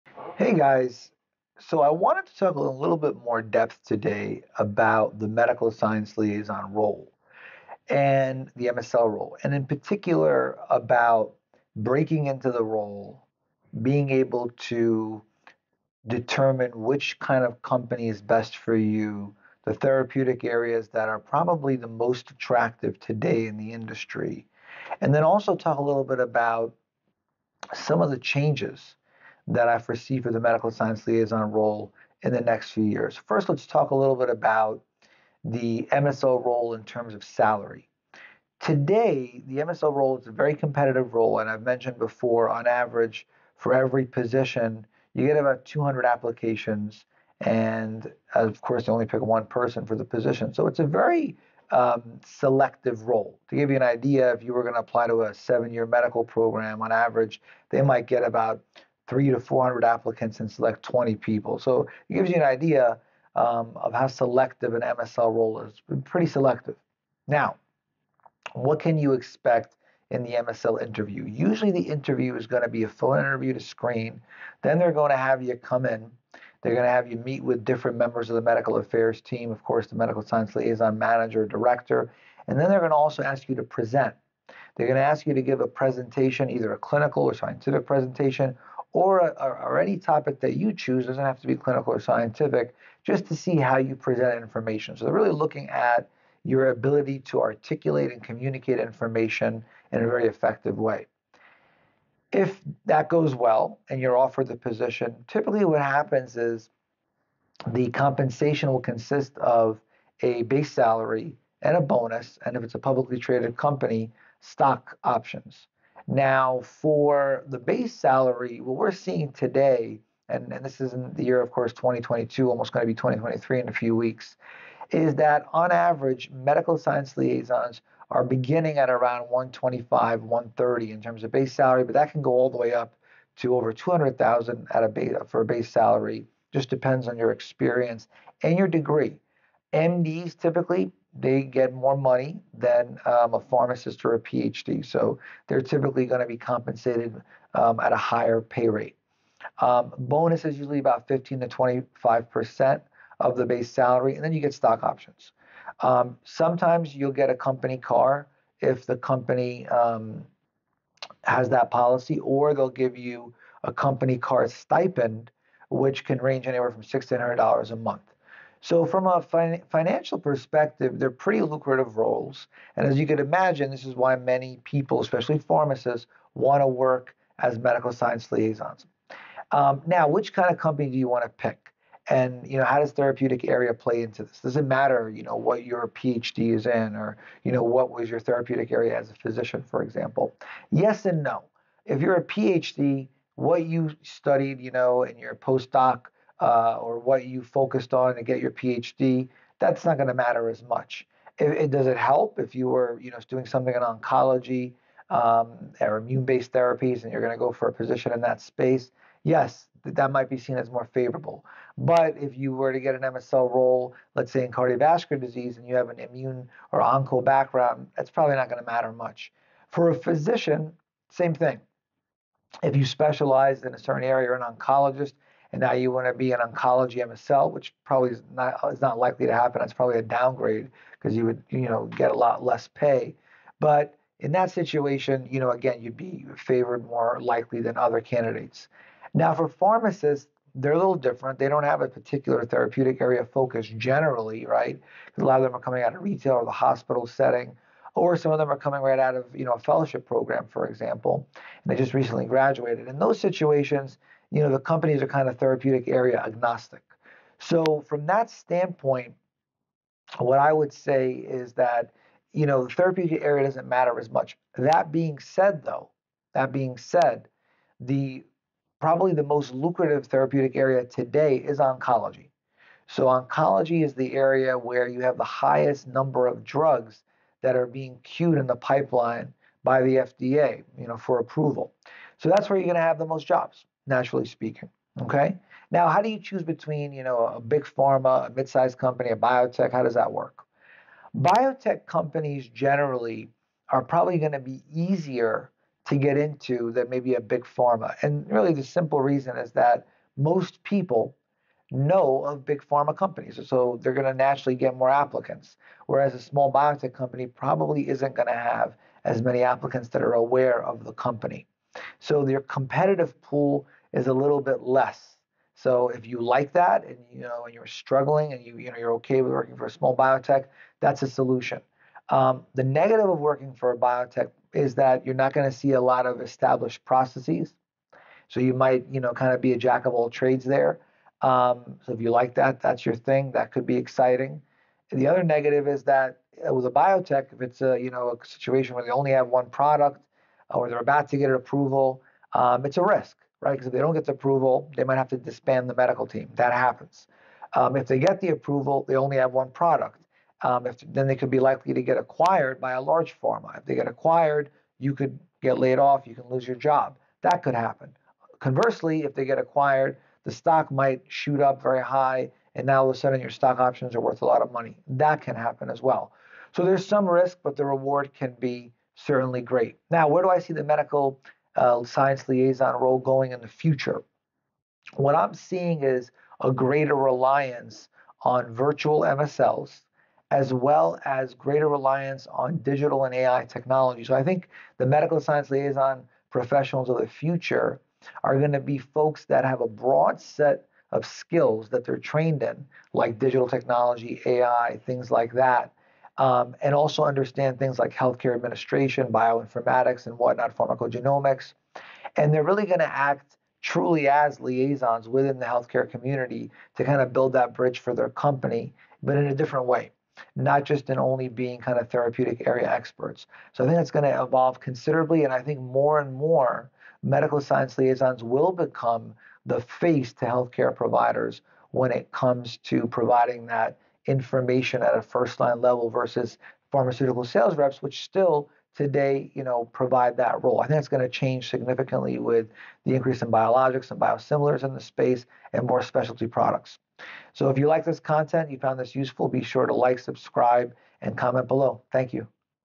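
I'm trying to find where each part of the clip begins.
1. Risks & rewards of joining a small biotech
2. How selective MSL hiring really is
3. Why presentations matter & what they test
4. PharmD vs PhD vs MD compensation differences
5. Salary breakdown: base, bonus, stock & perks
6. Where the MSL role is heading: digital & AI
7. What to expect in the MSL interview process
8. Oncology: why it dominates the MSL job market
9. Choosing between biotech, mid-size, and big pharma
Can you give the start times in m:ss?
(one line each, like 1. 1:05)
1. 4:54
2. 0:37
3. 1:27
4. 2:06
5. 1:47
6. 6:10
7. 1:11
8. 3:03
9. 3:51.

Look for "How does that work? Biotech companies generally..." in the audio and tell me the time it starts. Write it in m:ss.
4:49.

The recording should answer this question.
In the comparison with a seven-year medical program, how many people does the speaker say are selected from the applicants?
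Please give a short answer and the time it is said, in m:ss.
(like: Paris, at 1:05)
20, at 1:00.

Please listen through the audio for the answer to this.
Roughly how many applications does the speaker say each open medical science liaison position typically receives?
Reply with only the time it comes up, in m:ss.
0:45.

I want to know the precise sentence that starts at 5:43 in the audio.
Because if they don't get the approval, they might have to disband the medical team.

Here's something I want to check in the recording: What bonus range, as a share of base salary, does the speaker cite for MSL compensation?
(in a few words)
15 to 25%.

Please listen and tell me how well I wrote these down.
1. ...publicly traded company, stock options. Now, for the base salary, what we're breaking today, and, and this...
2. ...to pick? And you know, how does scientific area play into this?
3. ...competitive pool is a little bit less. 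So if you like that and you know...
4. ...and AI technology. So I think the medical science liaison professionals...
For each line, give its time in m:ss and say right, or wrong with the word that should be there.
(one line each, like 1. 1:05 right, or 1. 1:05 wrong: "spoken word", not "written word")
1. 1:52 wrong: "seeing", not "breaking"
2. 3:01 wrong: "therapeutic", not "scientific"
3. 5:12 right
4. 6:23 right.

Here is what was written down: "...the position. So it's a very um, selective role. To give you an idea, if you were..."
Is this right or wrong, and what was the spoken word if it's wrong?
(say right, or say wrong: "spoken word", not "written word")
right.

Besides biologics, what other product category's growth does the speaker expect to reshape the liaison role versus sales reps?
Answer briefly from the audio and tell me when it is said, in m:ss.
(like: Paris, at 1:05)
Biosimilars, at 7:13.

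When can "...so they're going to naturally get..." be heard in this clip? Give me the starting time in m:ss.
5:03.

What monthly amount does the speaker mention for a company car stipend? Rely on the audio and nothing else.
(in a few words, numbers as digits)
$1,600.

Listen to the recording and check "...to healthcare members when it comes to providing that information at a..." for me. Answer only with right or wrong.
wrong.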